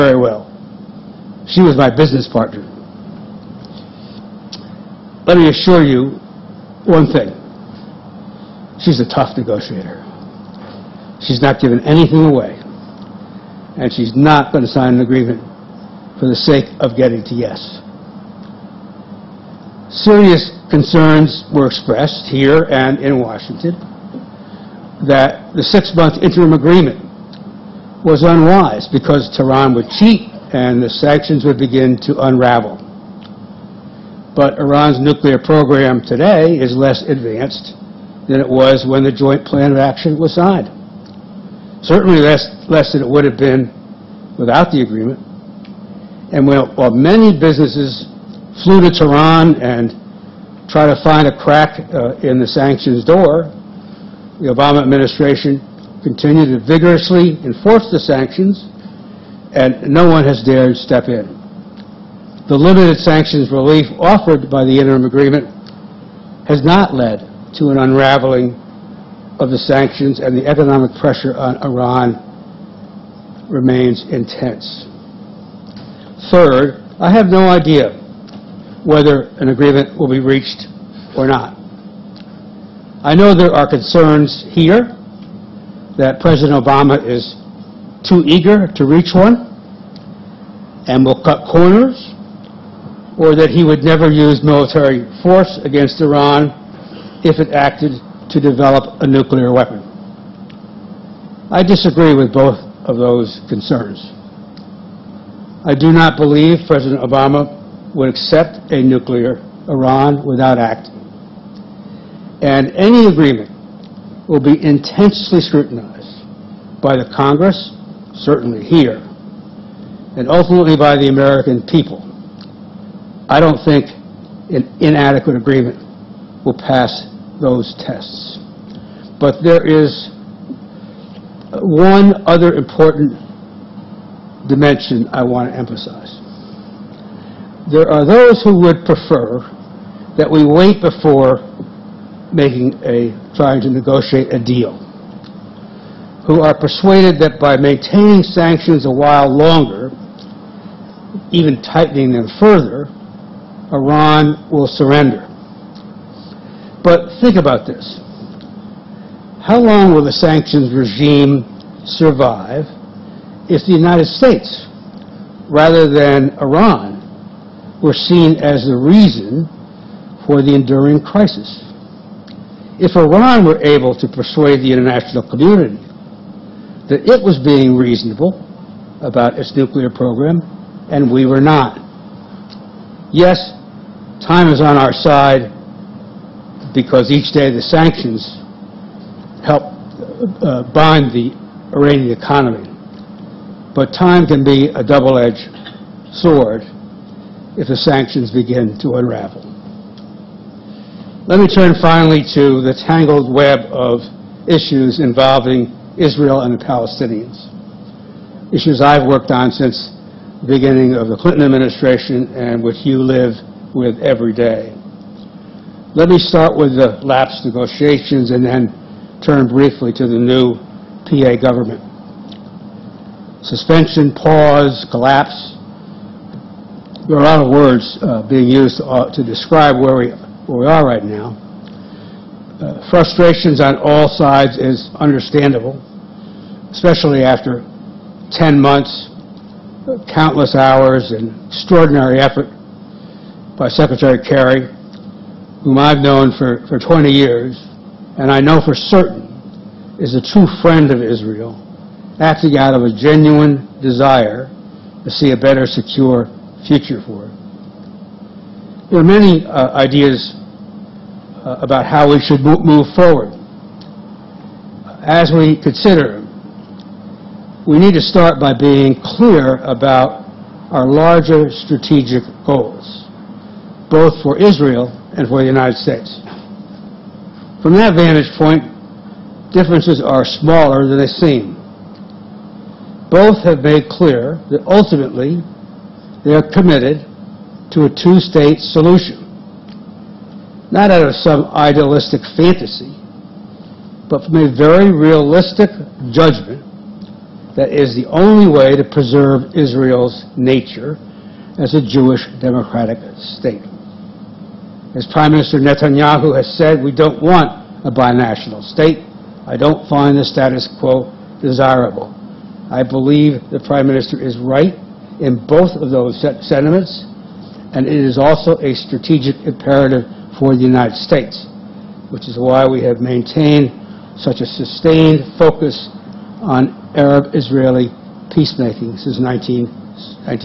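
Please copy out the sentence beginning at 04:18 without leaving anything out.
There are many uh, ideas uh, about how we should move forward.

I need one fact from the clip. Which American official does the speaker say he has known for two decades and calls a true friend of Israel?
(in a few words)
Secretary Kerry.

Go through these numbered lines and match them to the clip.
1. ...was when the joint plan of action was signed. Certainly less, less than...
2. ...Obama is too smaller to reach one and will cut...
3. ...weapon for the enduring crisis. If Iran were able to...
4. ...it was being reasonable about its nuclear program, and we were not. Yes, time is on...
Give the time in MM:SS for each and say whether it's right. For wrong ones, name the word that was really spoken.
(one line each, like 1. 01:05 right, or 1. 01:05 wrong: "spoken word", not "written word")
1. 00:38 right
2. 01:26 wrong: "eager", not "smaller"
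3. 02:48 wrong: "reason", not "weapon"
4. 02:57 right.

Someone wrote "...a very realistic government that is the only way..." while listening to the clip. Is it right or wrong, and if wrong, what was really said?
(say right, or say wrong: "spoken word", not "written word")
wrong: "judgment", not "government".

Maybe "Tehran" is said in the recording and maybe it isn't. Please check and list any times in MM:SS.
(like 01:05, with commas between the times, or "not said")
00:29, 00:48.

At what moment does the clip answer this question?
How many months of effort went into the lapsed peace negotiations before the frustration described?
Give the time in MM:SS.
03:58.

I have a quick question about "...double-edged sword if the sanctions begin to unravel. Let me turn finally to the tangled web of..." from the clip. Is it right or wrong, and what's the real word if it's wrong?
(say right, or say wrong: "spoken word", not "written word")
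right.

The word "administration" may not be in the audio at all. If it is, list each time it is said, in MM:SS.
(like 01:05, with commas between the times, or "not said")
00:54, 03:31.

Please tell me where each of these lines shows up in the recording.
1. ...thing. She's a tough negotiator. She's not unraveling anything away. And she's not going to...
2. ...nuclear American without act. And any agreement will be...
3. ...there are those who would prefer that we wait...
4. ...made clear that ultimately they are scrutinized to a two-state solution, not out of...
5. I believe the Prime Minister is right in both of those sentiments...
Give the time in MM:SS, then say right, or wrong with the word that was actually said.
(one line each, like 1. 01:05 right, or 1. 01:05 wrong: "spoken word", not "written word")
1. 00:07 wrong: "giving", not "unraveling"
2. 01:48 wrong: "Iran", not "American"
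3. 02:17 right
4. 04:43 wrong: "committed", not "scrutinized"
5. 05:12 right.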